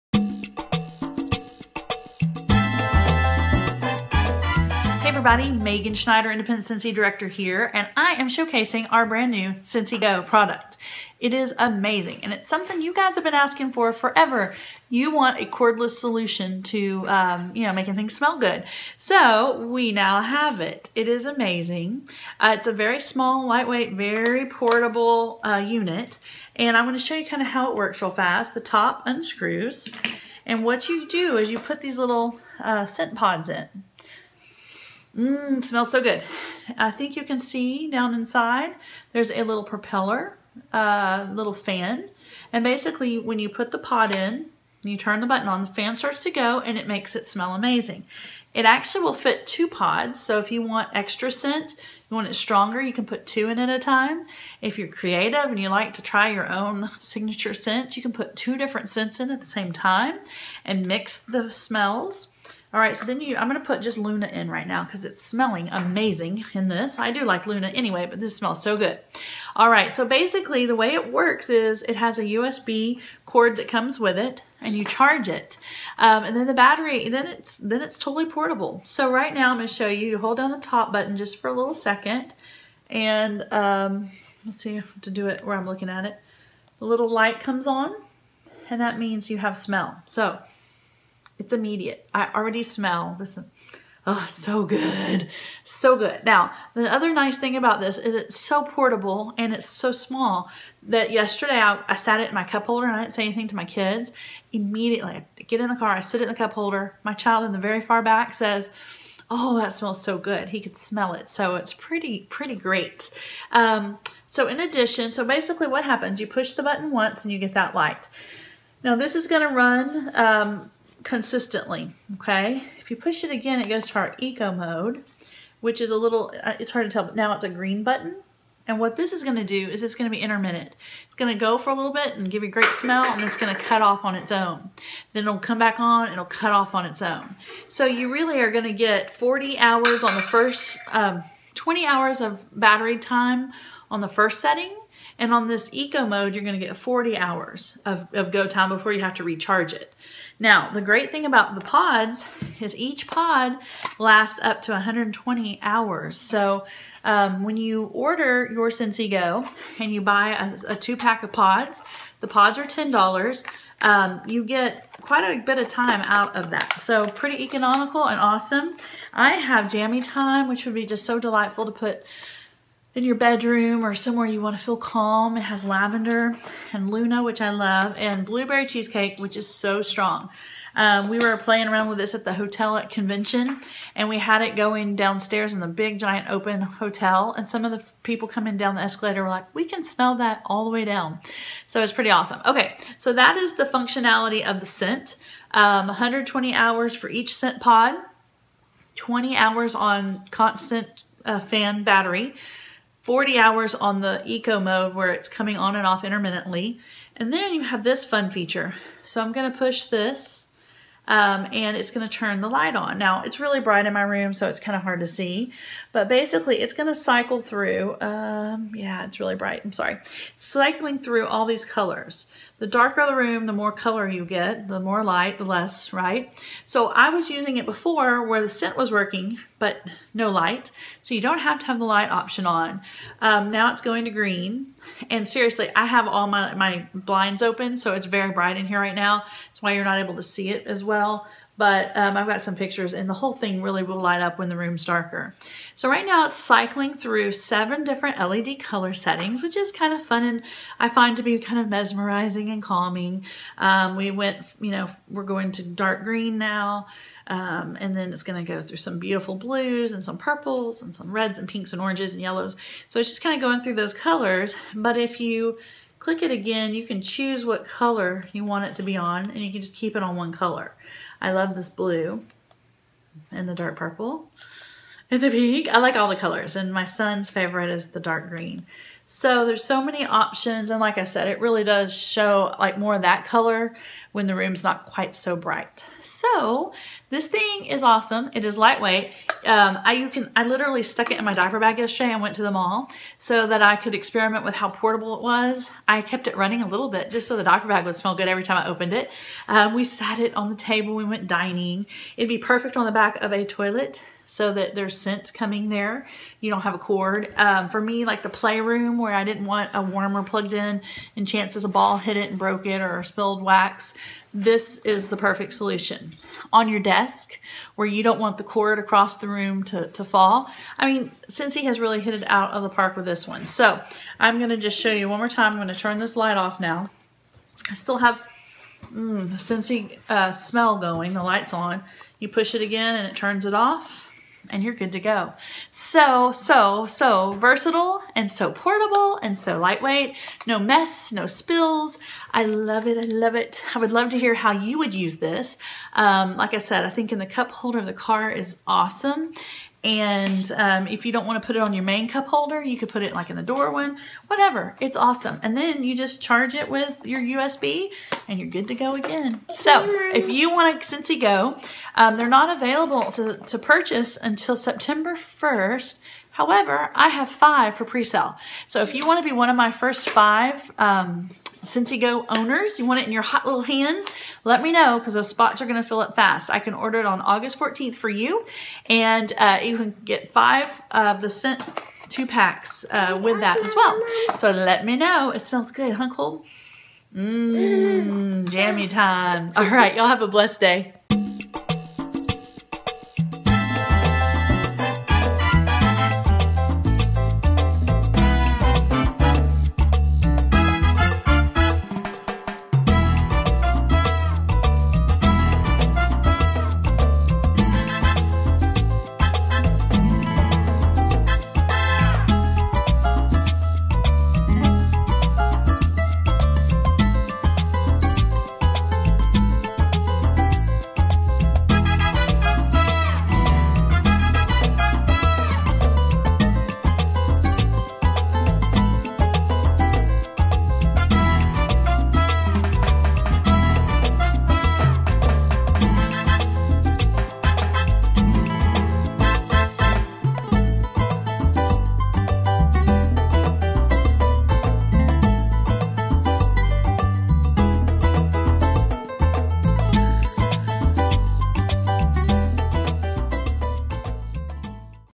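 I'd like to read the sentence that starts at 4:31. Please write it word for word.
I love this blue and the dark purple and the pink.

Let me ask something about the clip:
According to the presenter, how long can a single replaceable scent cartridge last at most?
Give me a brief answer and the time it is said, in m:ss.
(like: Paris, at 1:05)
120 hours, at 2:32.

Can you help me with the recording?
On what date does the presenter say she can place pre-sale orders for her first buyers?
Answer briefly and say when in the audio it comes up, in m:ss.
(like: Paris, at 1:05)
August 14, at 6:17.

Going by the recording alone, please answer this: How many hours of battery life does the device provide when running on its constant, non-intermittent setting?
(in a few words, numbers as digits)
20 hours.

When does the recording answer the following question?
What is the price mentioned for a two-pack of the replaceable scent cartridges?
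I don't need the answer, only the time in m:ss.
2:42.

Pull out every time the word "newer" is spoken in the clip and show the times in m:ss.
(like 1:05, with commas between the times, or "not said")
not said.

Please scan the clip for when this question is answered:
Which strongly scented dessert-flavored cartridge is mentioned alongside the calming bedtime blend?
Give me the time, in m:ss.
2:58.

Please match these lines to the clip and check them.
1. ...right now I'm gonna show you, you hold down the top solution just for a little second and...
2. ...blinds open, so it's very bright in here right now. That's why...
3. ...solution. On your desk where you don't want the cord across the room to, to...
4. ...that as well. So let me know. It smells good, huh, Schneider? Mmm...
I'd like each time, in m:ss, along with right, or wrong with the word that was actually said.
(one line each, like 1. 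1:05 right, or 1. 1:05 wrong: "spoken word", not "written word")
1. 1:19 wrong: "button", not "solution"
2. 3:56 right
3. 5:15 right
4. 6:23 wrong: "Cold", not "Schneider".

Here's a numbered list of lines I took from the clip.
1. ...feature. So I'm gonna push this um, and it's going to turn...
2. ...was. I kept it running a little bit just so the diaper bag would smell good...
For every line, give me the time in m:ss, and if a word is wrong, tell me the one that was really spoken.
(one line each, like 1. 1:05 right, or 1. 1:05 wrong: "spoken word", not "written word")
1. 3:28 right
2. 4:55 right.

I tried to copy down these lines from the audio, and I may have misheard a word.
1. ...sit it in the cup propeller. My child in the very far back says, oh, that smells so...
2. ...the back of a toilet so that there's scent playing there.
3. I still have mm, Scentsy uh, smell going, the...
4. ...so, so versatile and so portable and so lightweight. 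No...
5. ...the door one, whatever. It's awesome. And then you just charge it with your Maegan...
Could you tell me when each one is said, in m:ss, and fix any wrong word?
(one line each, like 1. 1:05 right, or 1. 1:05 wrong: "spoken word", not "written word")
1. 1:45 wrong: "holder", not "propeller"
2. 5:02 wrong: "coming", not "playing"
3. 5:27 right
4. 5:36 right
5. 5:53 wrong: "USB", not "Maegan".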